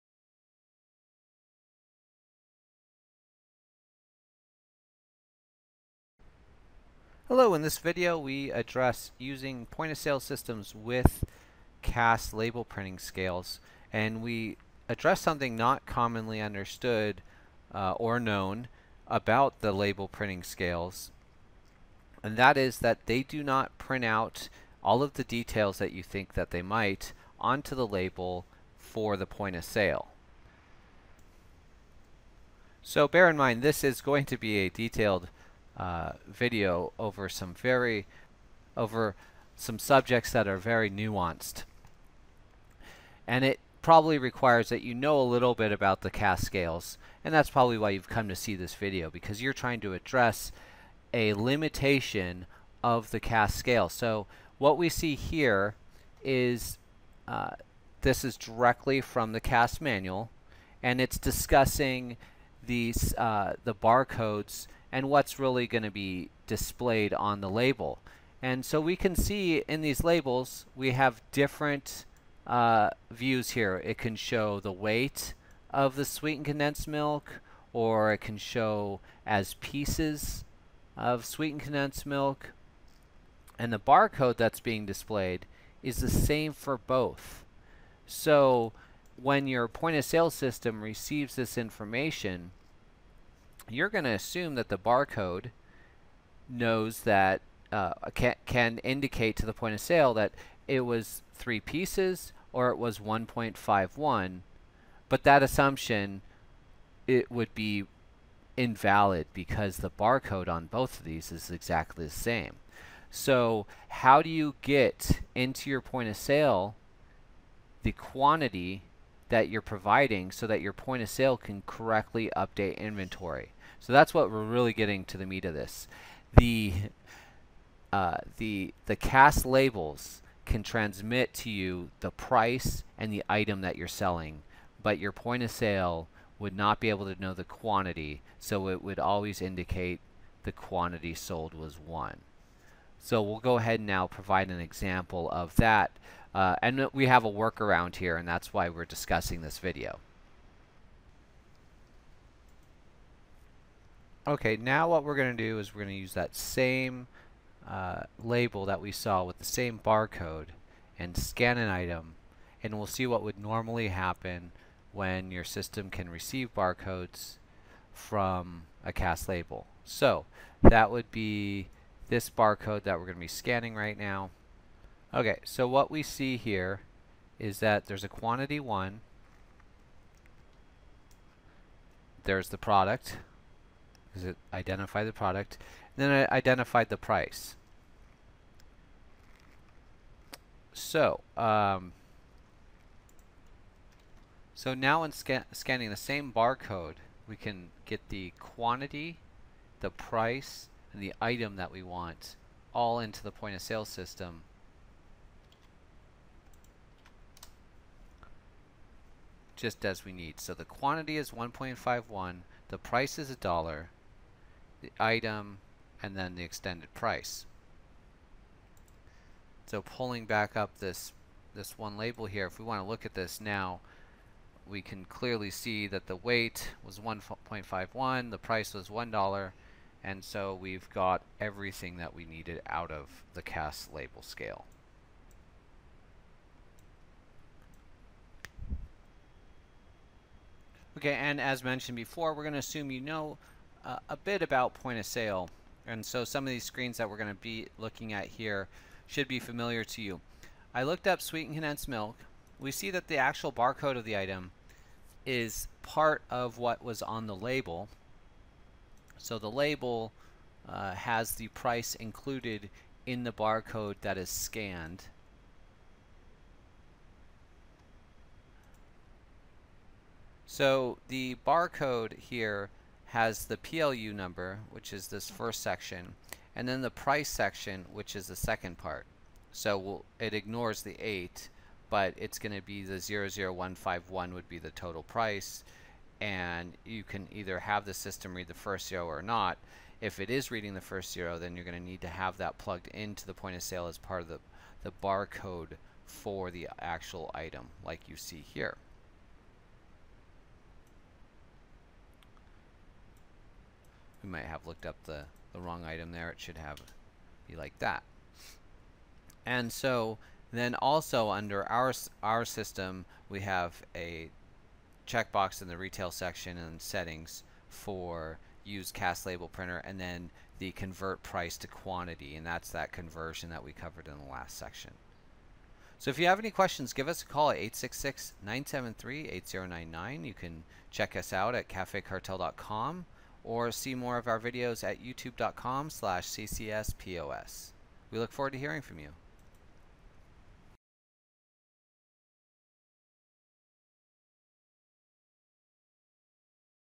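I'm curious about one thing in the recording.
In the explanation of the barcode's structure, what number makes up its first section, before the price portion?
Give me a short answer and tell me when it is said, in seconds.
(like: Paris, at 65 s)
PLU number, at 273 s.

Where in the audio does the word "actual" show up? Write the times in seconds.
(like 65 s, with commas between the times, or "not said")
253 s, 296 s.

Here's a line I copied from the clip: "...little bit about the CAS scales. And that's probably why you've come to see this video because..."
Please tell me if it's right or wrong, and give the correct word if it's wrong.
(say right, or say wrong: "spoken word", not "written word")
right.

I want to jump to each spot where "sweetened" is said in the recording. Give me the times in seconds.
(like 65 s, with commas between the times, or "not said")
76 s, 81 s, 251 s.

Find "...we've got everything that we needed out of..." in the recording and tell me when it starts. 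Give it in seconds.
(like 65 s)
230 s.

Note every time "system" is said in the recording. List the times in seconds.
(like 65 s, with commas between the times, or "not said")
10 s, 90 s, 165 s, 203 s, 287 s, 312 s.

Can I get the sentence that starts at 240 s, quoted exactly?
Okay, and as mentioned before, we're going to assume you know uh, a bit about point of sale.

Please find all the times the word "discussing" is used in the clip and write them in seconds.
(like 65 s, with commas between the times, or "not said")
61 s, 148 s.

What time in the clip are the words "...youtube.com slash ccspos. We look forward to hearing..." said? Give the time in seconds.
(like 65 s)
335 s.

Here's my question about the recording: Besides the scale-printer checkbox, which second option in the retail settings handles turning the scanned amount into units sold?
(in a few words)
Convert price to quantity.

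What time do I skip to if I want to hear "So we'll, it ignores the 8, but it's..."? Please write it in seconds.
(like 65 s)
279 s.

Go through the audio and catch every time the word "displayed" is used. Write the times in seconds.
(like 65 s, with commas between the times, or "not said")
66 s, 84 s.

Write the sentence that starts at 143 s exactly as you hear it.
So we'll go ahead and now provide an example of that.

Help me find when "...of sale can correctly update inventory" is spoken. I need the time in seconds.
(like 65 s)
121 s.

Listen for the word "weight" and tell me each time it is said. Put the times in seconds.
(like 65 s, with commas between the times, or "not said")
74 s, 226 s.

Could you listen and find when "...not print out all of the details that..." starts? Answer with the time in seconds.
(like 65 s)
23 s.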